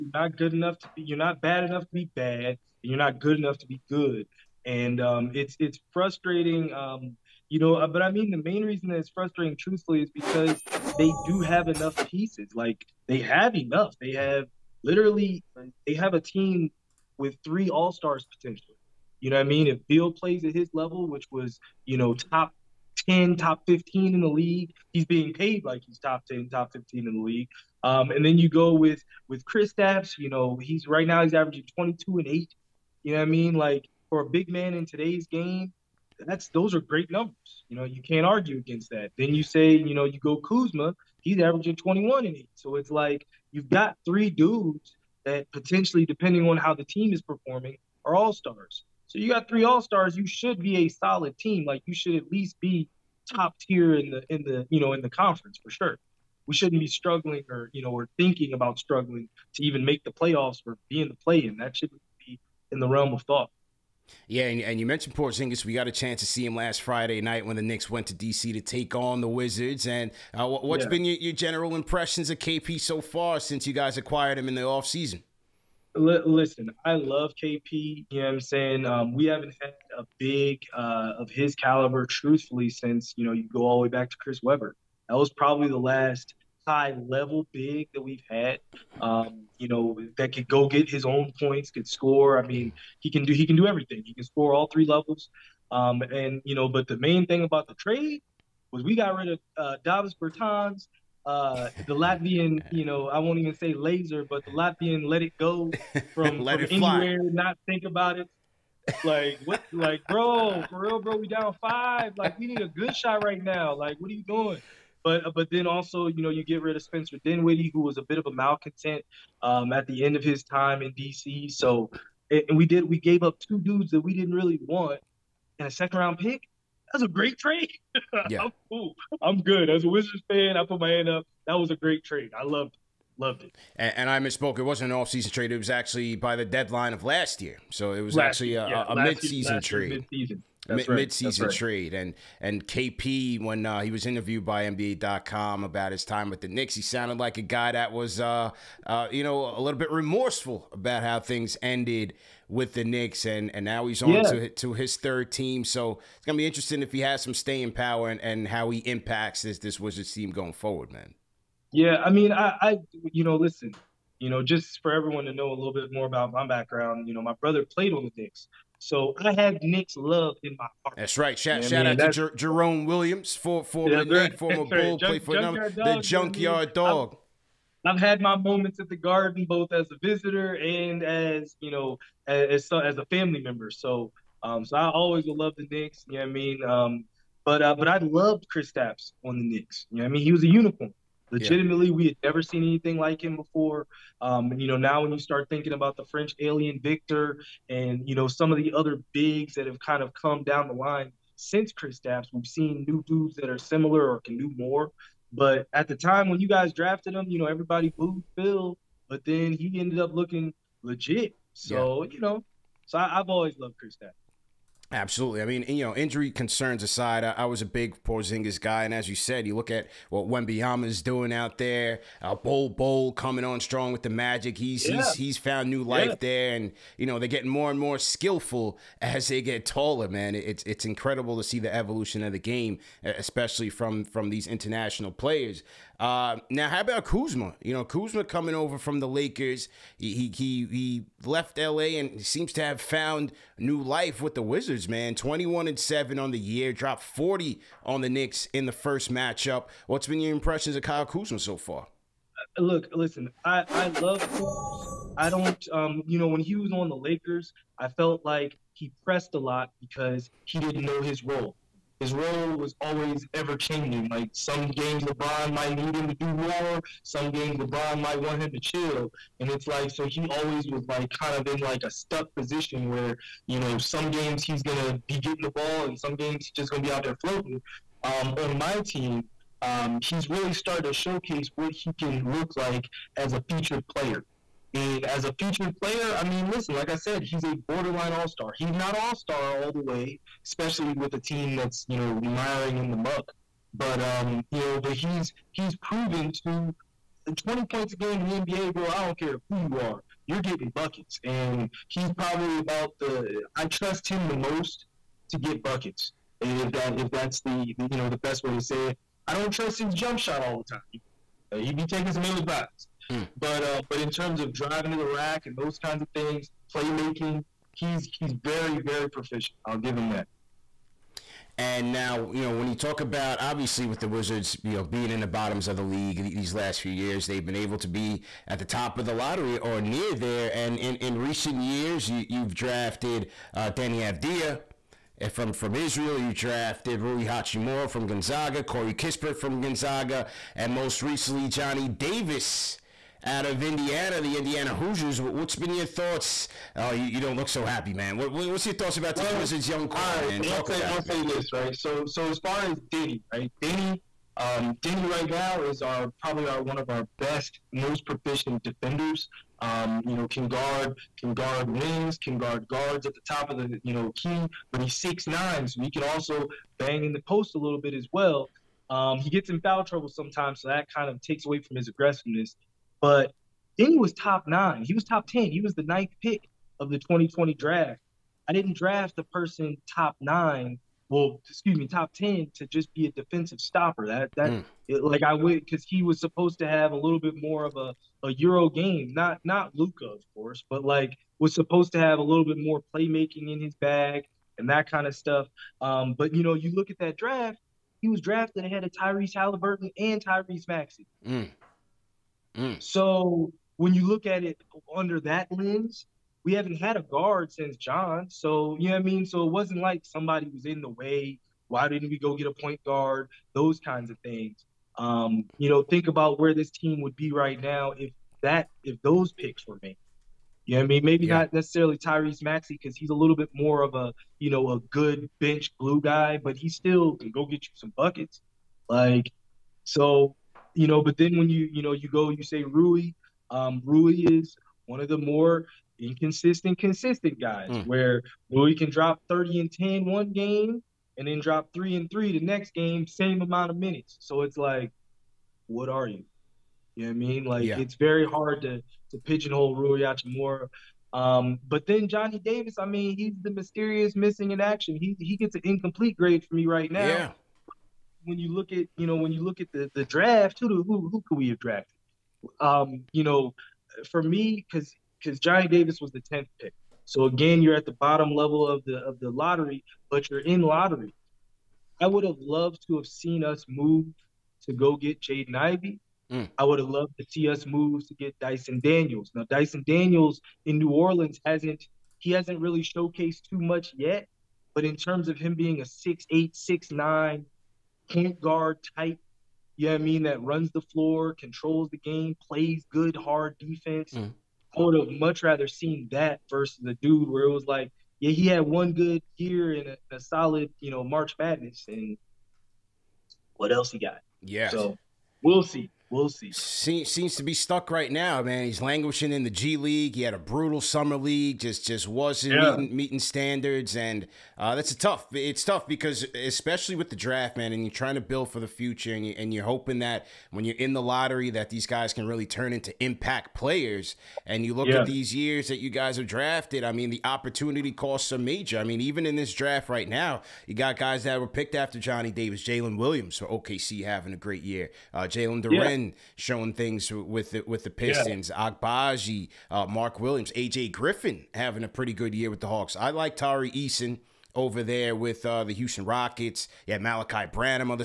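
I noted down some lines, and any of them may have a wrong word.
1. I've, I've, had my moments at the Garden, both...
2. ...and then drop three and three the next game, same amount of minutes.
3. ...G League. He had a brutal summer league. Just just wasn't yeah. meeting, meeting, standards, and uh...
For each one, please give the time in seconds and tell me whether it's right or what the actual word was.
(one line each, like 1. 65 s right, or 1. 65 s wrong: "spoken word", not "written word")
1. 177 s right
2. 441 s right
3. 509 s right.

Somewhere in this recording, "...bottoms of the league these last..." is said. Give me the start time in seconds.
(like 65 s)
325 s.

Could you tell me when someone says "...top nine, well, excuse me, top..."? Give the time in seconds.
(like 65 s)
379 s.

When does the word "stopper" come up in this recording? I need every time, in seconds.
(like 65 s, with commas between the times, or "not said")
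383 s.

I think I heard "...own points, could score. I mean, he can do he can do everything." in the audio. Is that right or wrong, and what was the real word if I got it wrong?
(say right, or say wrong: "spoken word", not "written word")
right.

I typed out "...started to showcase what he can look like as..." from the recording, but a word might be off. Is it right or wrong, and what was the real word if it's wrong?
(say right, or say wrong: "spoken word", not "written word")
right.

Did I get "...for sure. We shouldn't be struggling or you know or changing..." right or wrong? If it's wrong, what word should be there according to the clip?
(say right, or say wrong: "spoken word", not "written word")
wrong: "thinking", not "changing".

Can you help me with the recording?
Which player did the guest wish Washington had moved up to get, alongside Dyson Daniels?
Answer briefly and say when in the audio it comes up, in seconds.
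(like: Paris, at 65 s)
Jaden Ivey, at 475 s.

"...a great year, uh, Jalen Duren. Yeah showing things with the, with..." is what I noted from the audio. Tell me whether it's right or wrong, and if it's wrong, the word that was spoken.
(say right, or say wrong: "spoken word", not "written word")
right.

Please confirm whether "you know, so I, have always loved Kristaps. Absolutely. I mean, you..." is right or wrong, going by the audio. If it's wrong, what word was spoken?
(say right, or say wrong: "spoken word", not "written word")
right.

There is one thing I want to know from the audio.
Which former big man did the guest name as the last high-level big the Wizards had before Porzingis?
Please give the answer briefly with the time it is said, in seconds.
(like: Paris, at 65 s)
Chris Webber, at 84 s.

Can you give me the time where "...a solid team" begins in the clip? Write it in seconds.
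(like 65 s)
50 s.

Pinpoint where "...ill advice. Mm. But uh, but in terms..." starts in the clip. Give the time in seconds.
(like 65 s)
312 s.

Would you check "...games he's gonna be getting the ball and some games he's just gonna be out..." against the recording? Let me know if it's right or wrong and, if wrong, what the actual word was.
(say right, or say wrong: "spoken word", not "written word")
right.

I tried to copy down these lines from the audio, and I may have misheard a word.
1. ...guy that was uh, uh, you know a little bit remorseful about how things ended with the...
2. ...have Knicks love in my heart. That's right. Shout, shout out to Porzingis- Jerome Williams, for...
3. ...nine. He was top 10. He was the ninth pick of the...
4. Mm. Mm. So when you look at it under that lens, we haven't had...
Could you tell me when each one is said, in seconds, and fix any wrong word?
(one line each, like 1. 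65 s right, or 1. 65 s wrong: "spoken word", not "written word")
1. 147 s right
2. 169 s wrong: "Jer", not "Porzingis"
3. 374 s right
4. 401 s right.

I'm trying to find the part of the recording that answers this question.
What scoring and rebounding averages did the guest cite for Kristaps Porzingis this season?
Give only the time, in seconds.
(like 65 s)
31 s.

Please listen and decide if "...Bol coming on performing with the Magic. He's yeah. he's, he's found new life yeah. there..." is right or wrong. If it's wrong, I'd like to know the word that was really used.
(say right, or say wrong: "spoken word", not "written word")
wrong: "strong", not "performing".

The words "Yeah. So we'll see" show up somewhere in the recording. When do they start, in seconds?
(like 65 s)
504 s.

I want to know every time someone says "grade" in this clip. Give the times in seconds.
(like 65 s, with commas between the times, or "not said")
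456 s.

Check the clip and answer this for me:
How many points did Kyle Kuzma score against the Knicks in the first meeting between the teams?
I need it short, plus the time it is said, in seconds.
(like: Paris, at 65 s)
40, at 247 s.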